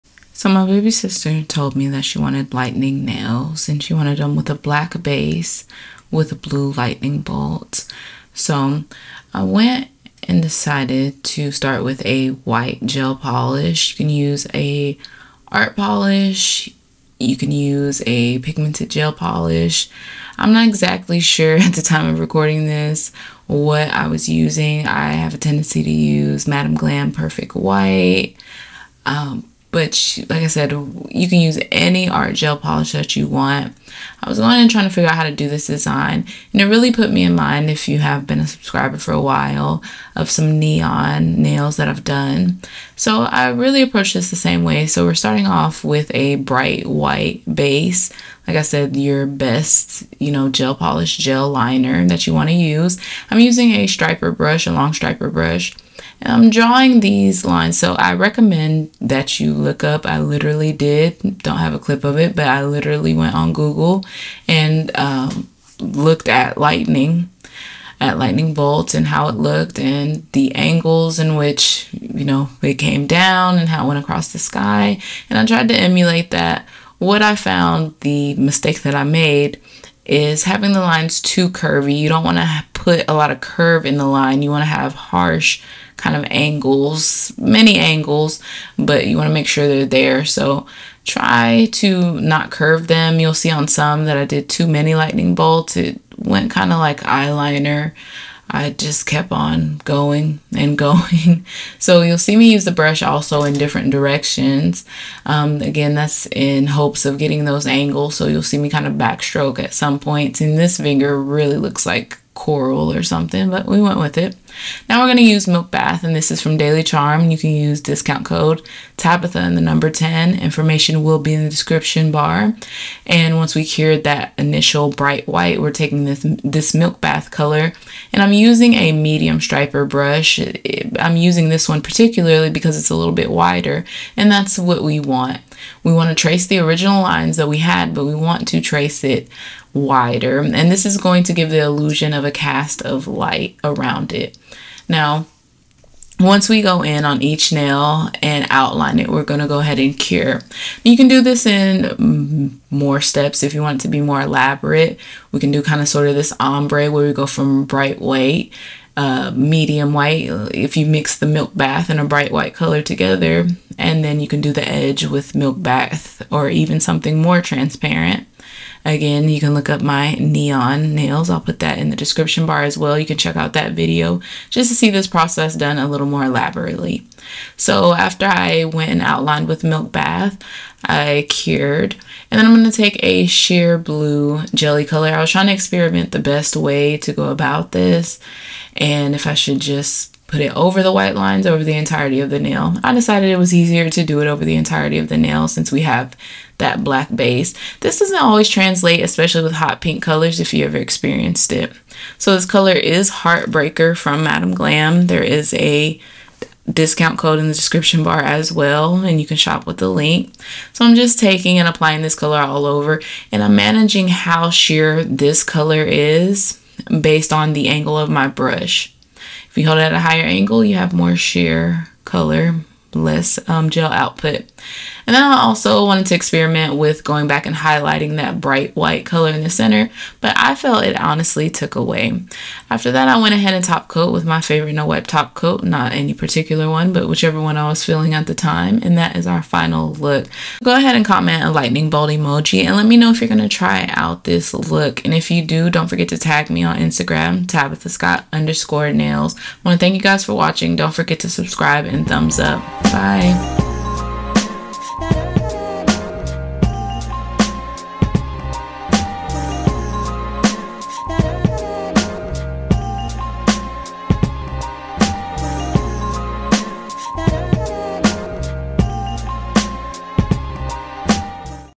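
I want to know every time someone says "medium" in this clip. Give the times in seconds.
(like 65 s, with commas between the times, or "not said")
128 s, 159 s.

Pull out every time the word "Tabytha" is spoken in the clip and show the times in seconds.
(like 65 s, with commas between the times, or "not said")
118 s, 247 s.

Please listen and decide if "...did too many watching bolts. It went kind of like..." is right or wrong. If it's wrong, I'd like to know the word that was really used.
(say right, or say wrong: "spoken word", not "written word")
wrong: "lightning", not "watching".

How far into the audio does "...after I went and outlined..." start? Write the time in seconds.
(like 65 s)
177 s.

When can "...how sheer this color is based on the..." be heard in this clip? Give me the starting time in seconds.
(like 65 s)
214 s.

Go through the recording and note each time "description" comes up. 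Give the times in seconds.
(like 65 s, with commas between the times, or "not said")
121 s, 171 s, 207 s.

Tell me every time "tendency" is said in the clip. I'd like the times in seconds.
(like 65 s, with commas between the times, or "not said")
25 s.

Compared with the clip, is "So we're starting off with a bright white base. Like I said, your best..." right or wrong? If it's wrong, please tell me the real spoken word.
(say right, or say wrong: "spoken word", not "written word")
right.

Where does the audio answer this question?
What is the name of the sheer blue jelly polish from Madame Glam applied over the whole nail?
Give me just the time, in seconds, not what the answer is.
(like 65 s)
203 s.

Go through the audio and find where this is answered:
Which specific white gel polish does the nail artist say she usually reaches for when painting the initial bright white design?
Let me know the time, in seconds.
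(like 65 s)
26 s.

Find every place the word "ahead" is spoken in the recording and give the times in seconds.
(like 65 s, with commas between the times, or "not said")
149 s, 233 s, 240 s.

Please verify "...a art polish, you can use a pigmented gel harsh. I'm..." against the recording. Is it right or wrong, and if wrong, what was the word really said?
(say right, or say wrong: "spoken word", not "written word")
wrong: "polish", not "harsh".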